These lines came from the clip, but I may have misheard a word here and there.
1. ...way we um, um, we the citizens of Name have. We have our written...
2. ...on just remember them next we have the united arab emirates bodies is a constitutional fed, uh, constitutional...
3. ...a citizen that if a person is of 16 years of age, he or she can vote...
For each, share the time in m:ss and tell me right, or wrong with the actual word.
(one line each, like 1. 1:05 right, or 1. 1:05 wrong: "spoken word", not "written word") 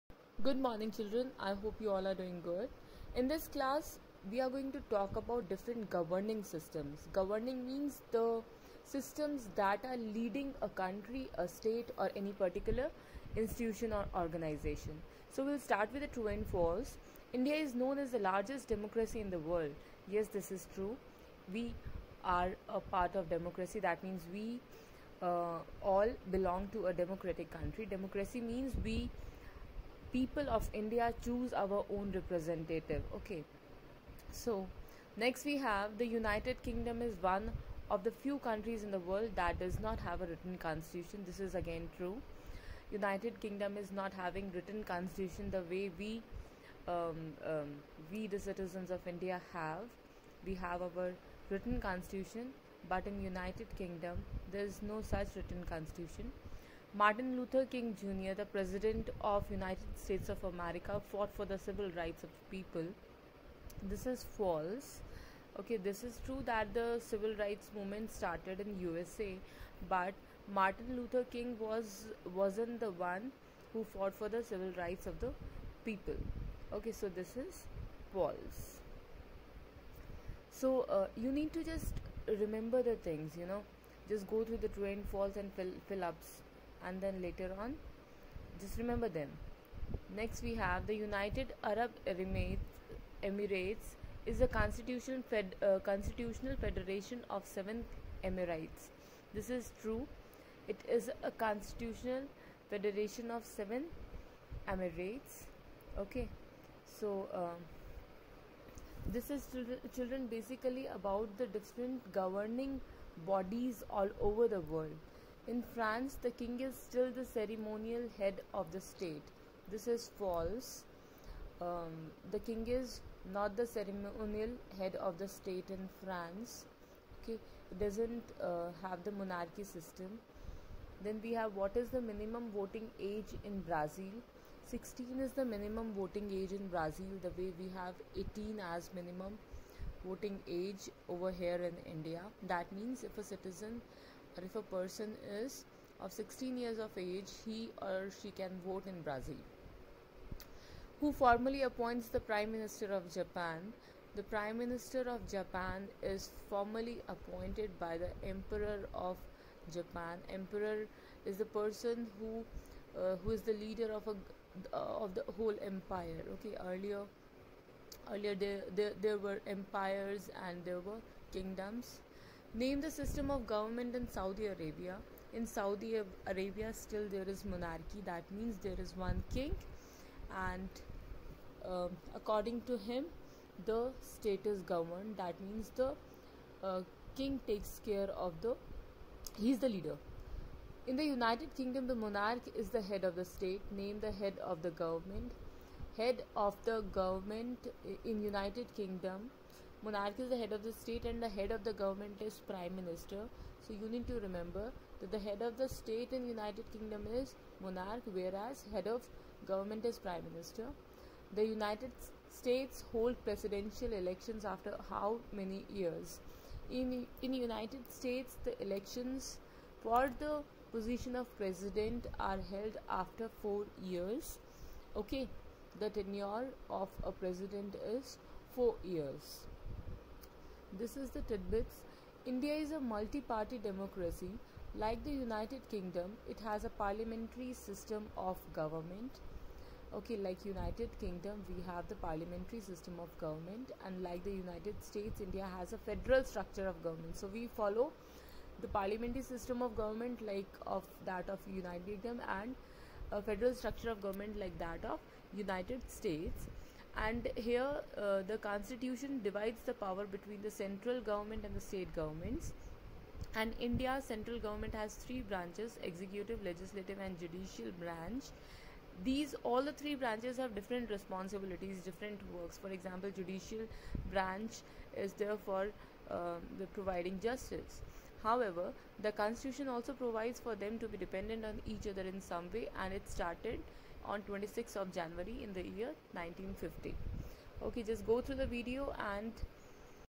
1. 0:45 wrong: "India", not "Name"
2. 1:27 wrong: "emirates", not "bodies"
3. 2:23 right.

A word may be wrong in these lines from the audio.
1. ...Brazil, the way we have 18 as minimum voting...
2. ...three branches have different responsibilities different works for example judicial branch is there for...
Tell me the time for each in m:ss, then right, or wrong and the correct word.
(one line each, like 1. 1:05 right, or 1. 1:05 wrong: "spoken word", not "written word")
1. 2:16 right
2. 4:29 right.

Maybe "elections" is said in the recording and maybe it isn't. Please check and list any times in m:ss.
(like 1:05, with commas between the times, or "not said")
3:34, 3:38.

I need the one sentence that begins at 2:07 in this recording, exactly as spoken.
Okay, it doesn't uh, have the monarchy system.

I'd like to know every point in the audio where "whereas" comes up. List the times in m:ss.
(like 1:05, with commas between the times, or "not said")
3:28.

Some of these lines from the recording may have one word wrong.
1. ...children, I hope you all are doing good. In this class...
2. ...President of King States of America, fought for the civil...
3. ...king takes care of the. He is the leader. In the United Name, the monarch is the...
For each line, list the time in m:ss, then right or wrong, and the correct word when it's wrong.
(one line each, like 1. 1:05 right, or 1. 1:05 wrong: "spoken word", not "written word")
1. 0:00 right
2. 0:58 wrong: "United", not "King"
3. 3:07 wrong: "Kingdom", not "Name".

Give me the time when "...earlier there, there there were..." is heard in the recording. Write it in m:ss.
2:48.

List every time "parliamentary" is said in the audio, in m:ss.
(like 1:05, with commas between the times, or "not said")
3:56, 4:01, 4:08.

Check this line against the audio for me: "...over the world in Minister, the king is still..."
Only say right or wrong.
wrong.